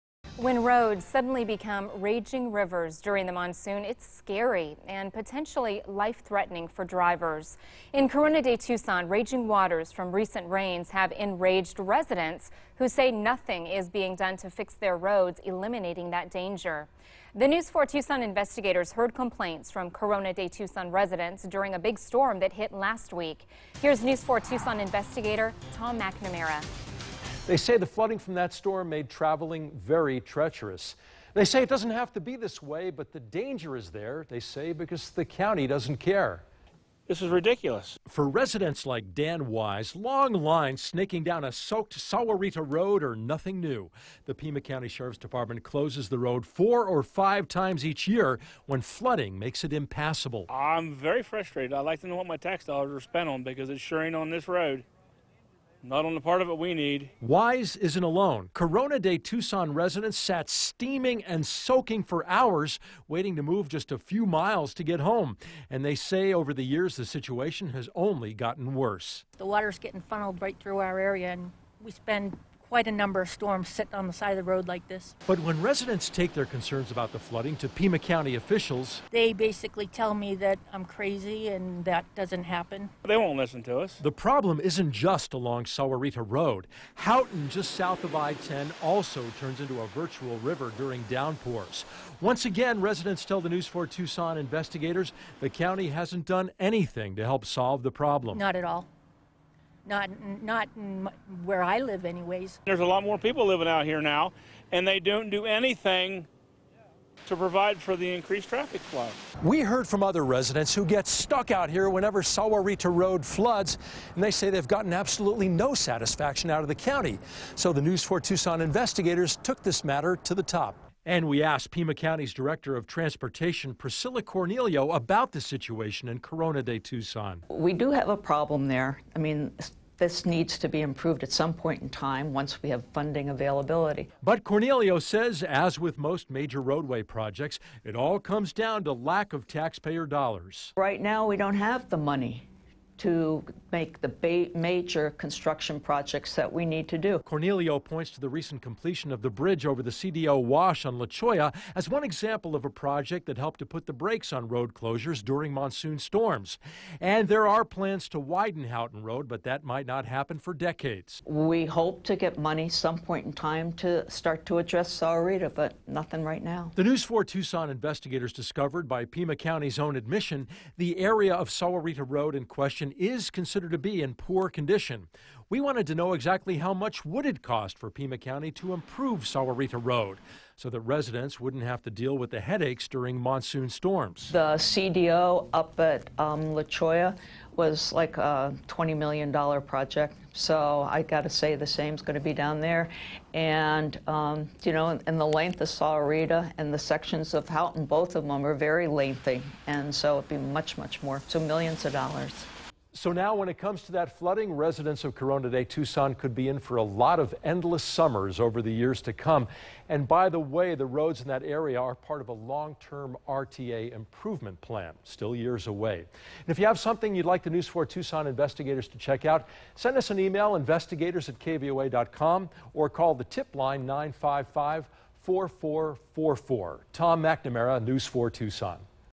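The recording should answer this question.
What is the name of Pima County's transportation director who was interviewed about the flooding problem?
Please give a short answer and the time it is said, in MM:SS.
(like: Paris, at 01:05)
Priscilla Cornelio, at 02:03.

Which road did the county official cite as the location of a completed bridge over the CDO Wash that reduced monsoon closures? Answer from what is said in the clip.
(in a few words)
La Cholla.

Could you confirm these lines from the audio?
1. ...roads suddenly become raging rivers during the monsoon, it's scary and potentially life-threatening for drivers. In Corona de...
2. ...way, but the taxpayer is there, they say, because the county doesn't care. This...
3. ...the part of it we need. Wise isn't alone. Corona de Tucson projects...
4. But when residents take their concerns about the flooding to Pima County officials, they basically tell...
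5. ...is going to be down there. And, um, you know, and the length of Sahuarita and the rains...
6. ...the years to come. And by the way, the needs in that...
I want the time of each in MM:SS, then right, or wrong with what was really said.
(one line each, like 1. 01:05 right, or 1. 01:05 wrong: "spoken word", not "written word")
1. 00:00 right
2. 00:32 wrong: "danger", not "taxpayer"
3. 00:56 wrong: "residents", not "projects"
4. 01:15 right
5. 03:11 wrong: "sections", not "rains"
6. 03:28 wrong: "roads", not "needs".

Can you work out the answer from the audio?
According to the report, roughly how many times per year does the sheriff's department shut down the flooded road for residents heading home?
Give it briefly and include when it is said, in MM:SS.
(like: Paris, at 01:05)
4 or 5, at 00:46.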